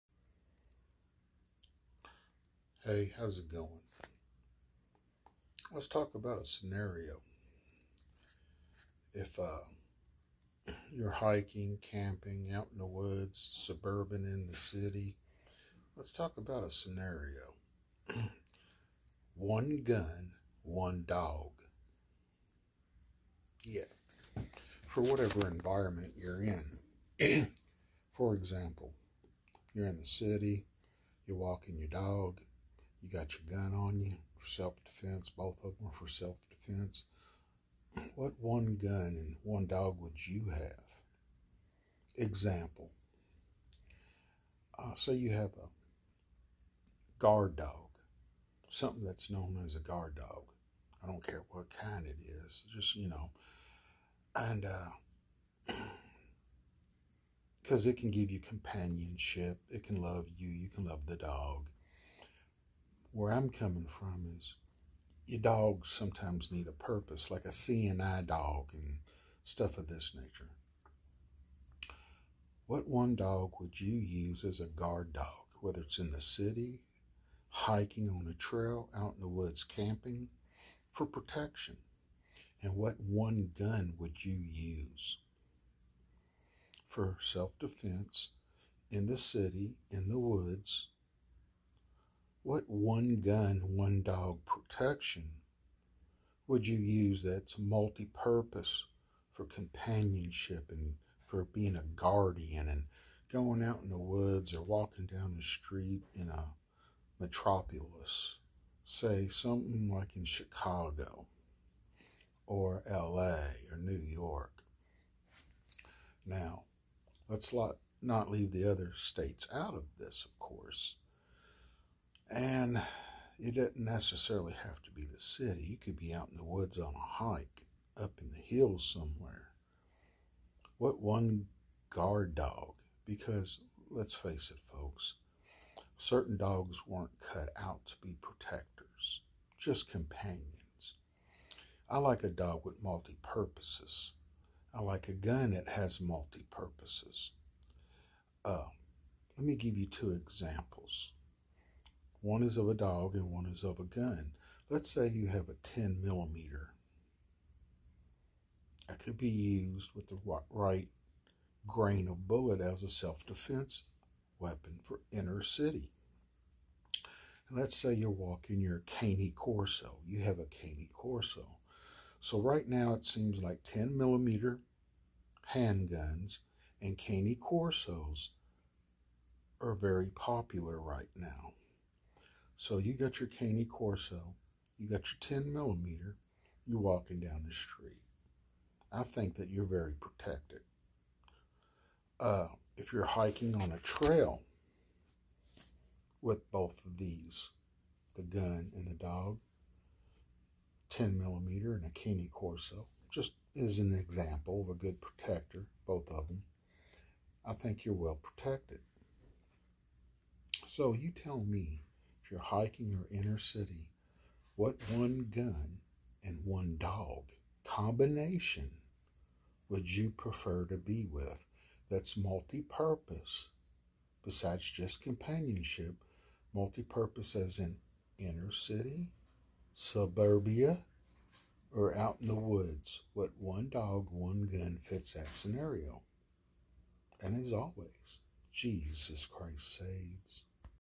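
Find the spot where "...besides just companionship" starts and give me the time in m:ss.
3:44.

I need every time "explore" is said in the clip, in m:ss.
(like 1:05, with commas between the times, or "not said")
not said.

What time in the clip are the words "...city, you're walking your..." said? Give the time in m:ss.
0:30.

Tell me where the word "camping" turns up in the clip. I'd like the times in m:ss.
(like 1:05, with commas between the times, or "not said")
0:11, 1:19.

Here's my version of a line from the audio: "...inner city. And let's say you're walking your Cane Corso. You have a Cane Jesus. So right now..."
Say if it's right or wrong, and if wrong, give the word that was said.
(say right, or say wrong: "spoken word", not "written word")
wrong: "Corso", not "Jesus".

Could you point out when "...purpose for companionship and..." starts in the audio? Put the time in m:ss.
1:38.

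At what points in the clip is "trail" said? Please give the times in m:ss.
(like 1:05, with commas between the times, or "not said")
1:18, 3:13.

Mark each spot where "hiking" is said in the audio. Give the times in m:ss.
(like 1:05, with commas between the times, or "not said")
0:11, 1:17, 3:13, 3:32.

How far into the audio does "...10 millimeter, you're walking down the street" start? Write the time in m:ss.
3:05.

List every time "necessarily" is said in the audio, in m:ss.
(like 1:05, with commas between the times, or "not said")
2:03.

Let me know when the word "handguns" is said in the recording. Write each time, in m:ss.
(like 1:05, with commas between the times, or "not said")
2:55.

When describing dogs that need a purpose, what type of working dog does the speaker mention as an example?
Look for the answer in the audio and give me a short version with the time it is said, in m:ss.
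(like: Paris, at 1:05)
CNI dog, at 1:07.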